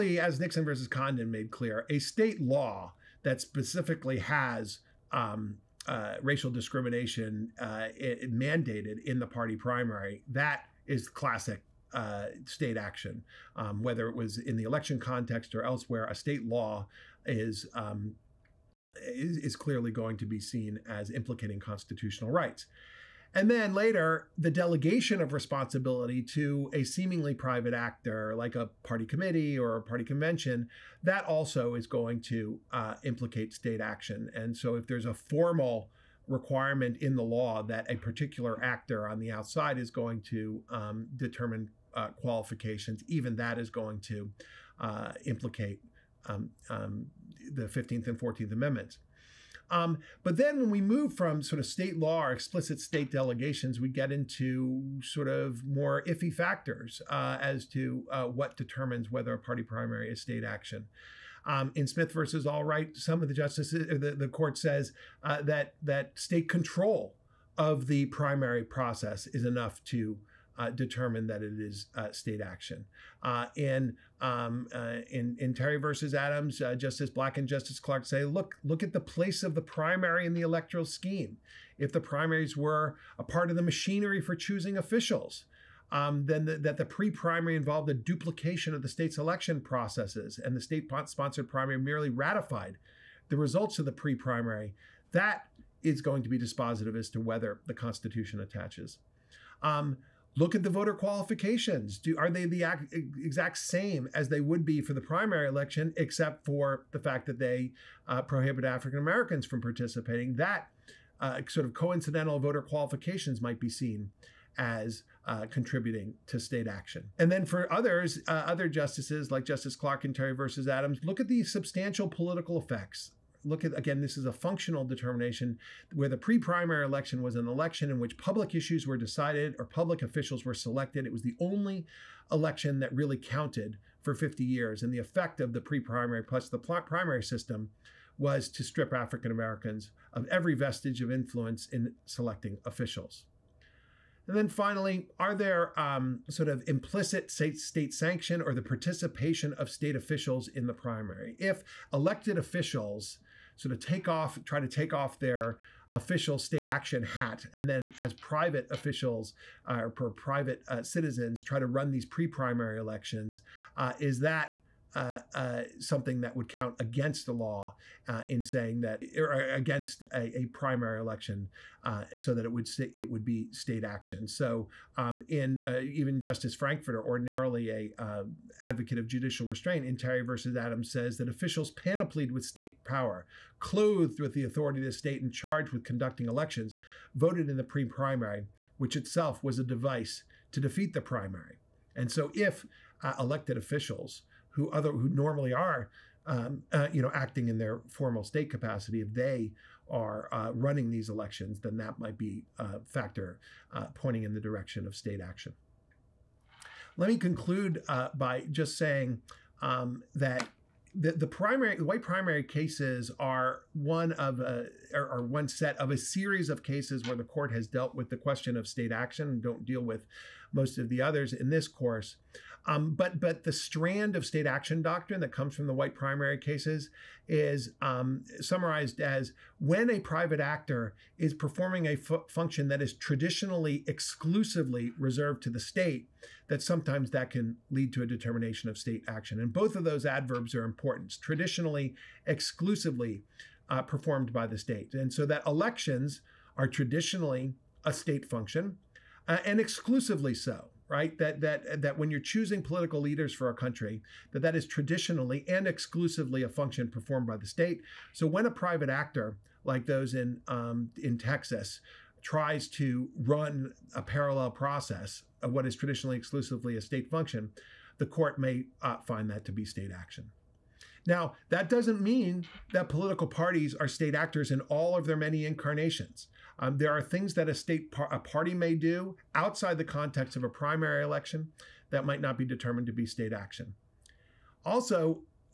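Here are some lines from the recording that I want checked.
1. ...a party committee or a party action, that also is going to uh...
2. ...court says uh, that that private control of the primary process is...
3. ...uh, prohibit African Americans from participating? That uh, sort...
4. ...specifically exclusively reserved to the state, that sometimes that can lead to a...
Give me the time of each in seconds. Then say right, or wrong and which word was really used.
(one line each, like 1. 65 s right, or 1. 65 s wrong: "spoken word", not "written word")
1. 28 s wrong: "convention", not "action"
2. 64 s wrong: "state", not "private"
3. 108 s right
4. 232 s wrong: "traditionally", not "specifically".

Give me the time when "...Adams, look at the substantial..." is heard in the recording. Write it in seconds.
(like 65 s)
120 s.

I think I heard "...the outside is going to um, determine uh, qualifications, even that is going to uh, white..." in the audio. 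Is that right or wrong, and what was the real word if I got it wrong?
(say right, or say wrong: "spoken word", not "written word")
wrong: "implicate", not "white".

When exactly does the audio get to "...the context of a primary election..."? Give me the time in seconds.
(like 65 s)
279 s.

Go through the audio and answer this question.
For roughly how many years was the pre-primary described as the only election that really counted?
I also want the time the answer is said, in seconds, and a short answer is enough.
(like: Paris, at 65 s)
50, at 134 s.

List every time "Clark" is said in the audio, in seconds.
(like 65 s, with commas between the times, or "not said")
77 s, 119 s.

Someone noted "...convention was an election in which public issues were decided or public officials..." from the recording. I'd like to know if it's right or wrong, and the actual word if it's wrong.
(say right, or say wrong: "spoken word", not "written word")
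wrong: "election", not "convention".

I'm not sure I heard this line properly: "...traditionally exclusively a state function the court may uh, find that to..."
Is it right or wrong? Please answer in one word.
right.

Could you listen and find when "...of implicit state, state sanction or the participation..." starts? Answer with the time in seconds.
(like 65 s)
146 s.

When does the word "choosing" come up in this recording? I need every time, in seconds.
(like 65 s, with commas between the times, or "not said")
84 s, 252 s.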